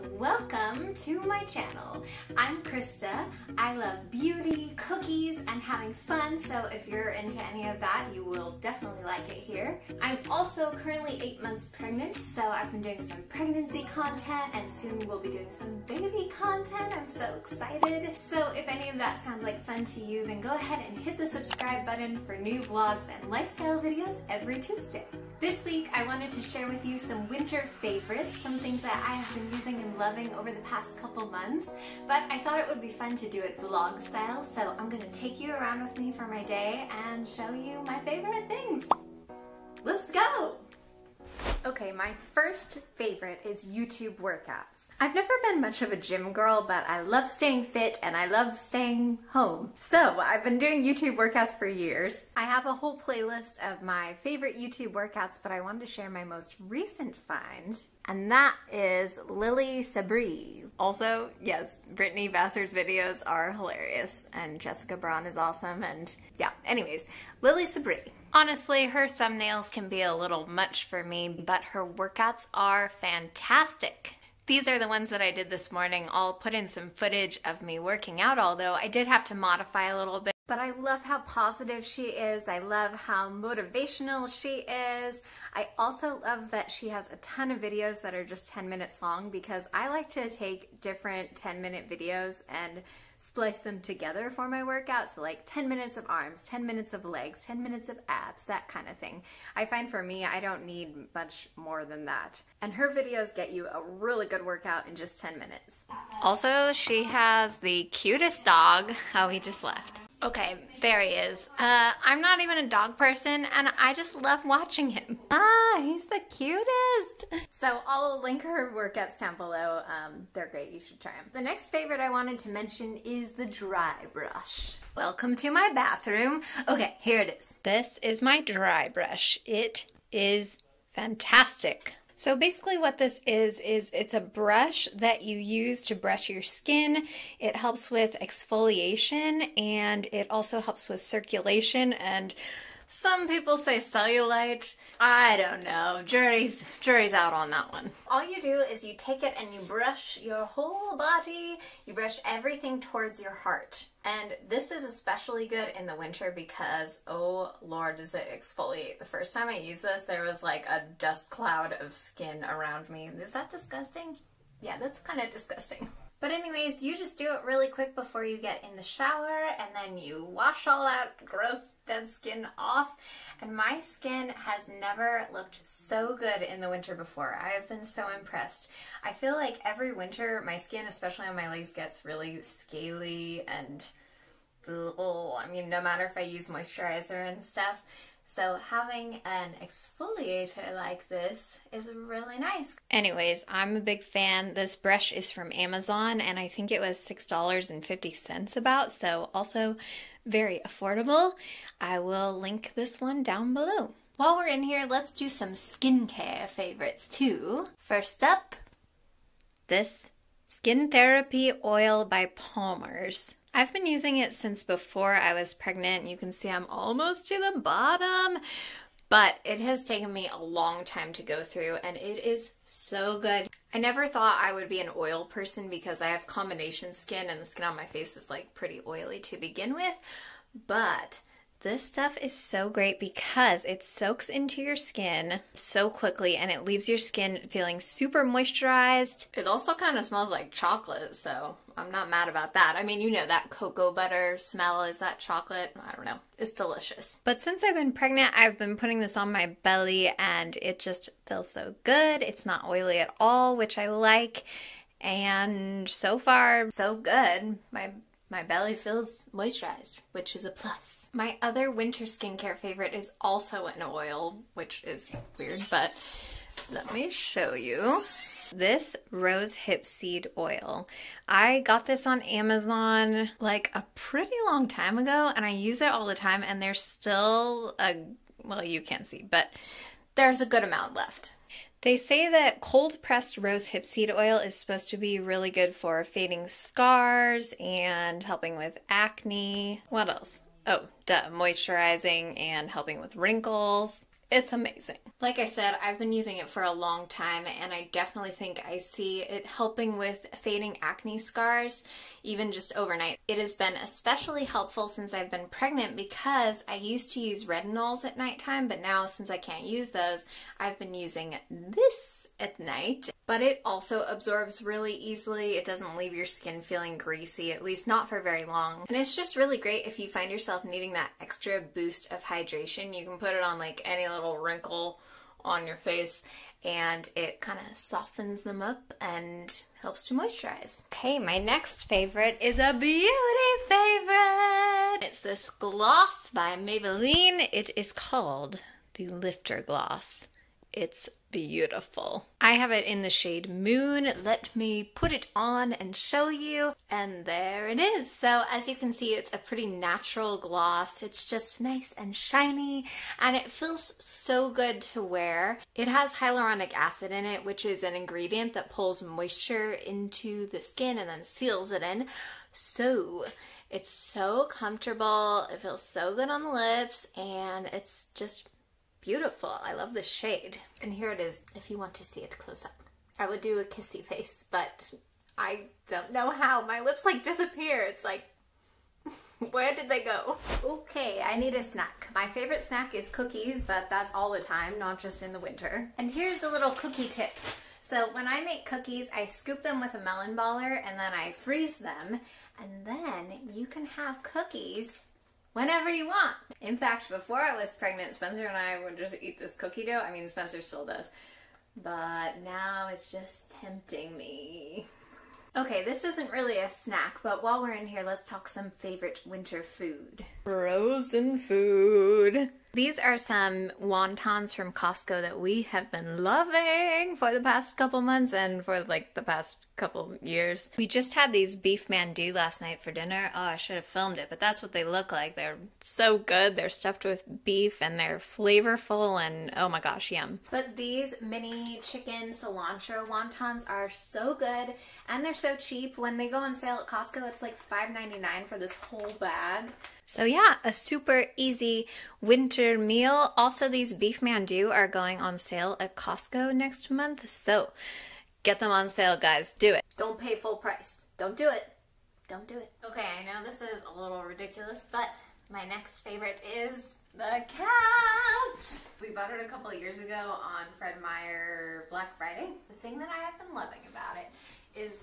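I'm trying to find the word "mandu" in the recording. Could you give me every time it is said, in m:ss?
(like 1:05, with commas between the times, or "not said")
7:01, 7:24.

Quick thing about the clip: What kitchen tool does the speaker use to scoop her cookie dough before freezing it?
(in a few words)
melon baller.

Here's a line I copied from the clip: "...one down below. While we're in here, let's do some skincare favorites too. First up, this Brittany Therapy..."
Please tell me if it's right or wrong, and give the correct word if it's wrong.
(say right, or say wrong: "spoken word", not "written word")
wrong: "Skin", not "Brittany".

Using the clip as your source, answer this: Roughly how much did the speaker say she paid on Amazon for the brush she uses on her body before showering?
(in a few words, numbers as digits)
$6.50.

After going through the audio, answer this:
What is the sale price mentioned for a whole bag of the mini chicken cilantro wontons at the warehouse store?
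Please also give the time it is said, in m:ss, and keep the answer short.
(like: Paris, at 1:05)
$5.99, at 7:17.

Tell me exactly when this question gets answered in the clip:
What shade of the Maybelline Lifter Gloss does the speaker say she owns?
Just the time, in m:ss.
5:43.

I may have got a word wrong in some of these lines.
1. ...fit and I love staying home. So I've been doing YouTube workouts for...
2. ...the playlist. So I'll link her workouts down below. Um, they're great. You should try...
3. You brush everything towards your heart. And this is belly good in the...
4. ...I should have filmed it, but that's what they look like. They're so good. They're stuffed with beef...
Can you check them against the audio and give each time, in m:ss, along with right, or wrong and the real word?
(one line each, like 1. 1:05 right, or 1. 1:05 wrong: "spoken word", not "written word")
1. 0:47 right
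2. 1:56 wrong: "cutest", not "playlist"
3. 2:31 wrong: "especially", not "belly"
4. 7:03 right.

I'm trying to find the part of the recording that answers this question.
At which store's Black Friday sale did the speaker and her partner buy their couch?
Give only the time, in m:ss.
7:40.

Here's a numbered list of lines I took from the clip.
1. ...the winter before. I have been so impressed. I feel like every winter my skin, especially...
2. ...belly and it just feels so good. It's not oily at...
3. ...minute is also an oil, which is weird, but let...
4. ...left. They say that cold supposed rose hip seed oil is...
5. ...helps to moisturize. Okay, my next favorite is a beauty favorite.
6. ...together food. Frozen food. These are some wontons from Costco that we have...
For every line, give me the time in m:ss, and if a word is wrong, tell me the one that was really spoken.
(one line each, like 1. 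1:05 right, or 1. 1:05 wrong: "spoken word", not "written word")
1. 2:56 right
2. 4:09 right
3. 4:22 wrong: "favorite", not "minute"
4. 4:40 wrong: "pressed", not "supposed"
5. 5:29 right
6. 6:49 wrong: "winter", not "together".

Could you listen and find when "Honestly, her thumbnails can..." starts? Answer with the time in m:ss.
1:08.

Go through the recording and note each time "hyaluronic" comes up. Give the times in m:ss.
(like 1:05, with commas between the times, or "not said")
5:56.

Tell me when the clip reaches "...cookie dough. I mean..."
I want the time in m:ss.
6:39.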